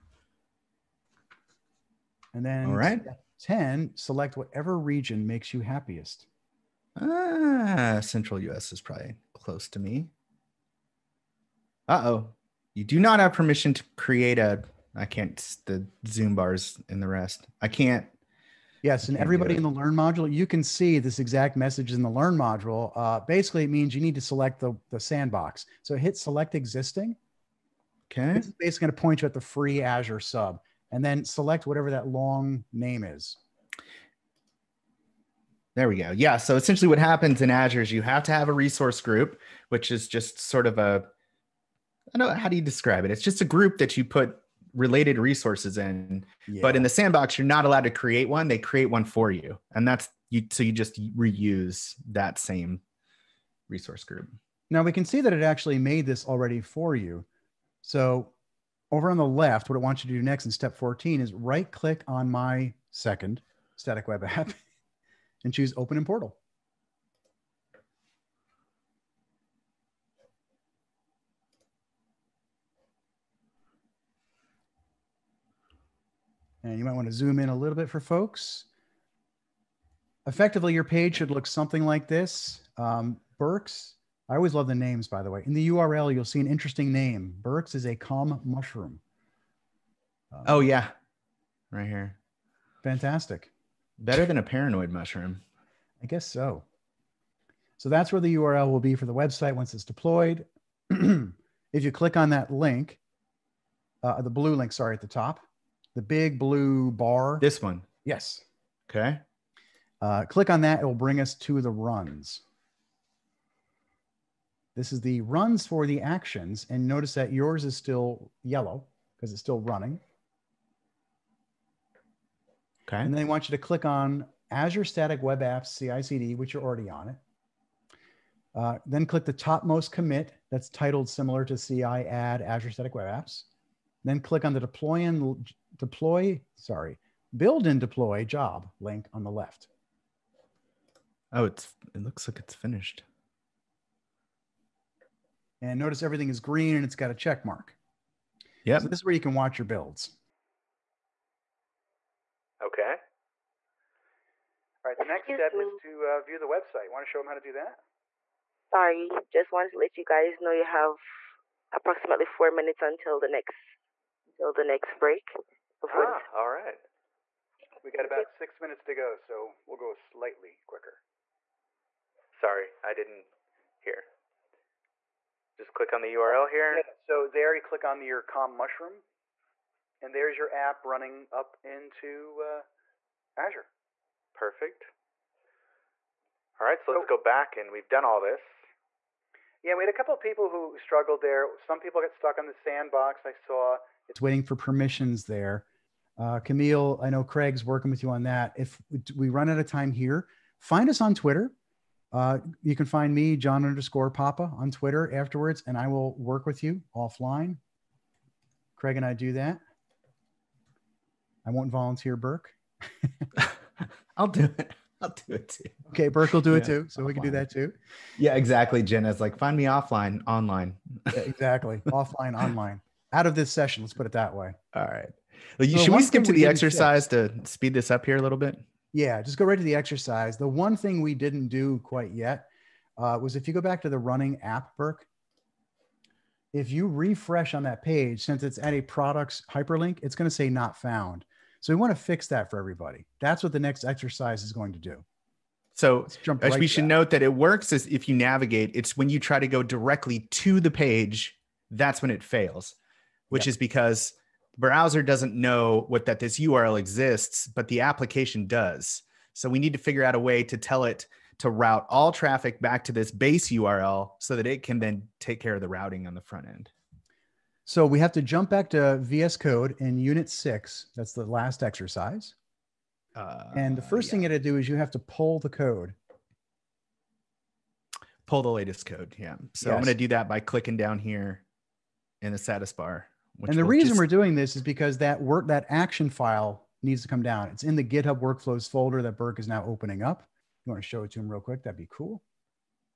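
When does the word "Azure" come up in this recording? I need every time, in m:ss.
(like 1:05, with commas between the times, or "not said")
0:29, 0:37, 2:04, 2:12, 3:03.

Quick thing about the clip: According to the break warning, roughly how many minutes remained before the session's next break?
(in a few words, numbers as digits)
4.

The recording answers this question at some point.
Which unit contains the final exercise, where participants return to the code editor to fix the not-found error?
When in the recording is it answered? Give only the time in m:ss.
4:29.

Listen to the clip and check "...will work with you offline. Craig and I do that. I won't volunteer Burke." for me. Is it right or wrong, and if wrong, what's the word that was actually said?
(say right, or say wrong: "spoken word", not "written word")
right.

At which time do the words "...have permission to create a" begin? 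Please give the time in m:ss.
0:13.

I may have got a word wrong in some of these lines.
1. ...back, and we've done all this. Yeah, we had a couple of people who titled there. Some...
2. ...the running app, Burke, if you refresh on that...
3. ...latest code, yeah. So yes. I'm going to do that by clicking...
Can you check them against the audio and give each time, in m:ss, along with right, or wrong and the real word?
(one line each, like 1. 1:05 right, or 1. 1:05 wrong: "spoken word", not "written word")
1. 3:07 wrong: "struggled", not "titled"
2. 3:53 right
3. 4:38 right.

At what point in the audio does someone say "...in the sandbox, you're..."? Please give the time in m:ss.
0:46.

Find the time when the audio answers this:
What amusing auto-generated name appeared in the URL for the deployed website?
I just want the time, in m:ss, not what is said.
1:27.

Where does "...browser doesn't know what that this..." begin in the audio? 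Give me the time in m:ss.
4:14.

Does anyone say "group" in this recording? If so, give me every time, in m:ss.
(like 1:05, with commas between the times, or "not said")
0:38, 0:43, 0:54.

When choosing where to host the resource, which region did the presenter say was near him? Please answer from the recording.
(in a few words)
Central US.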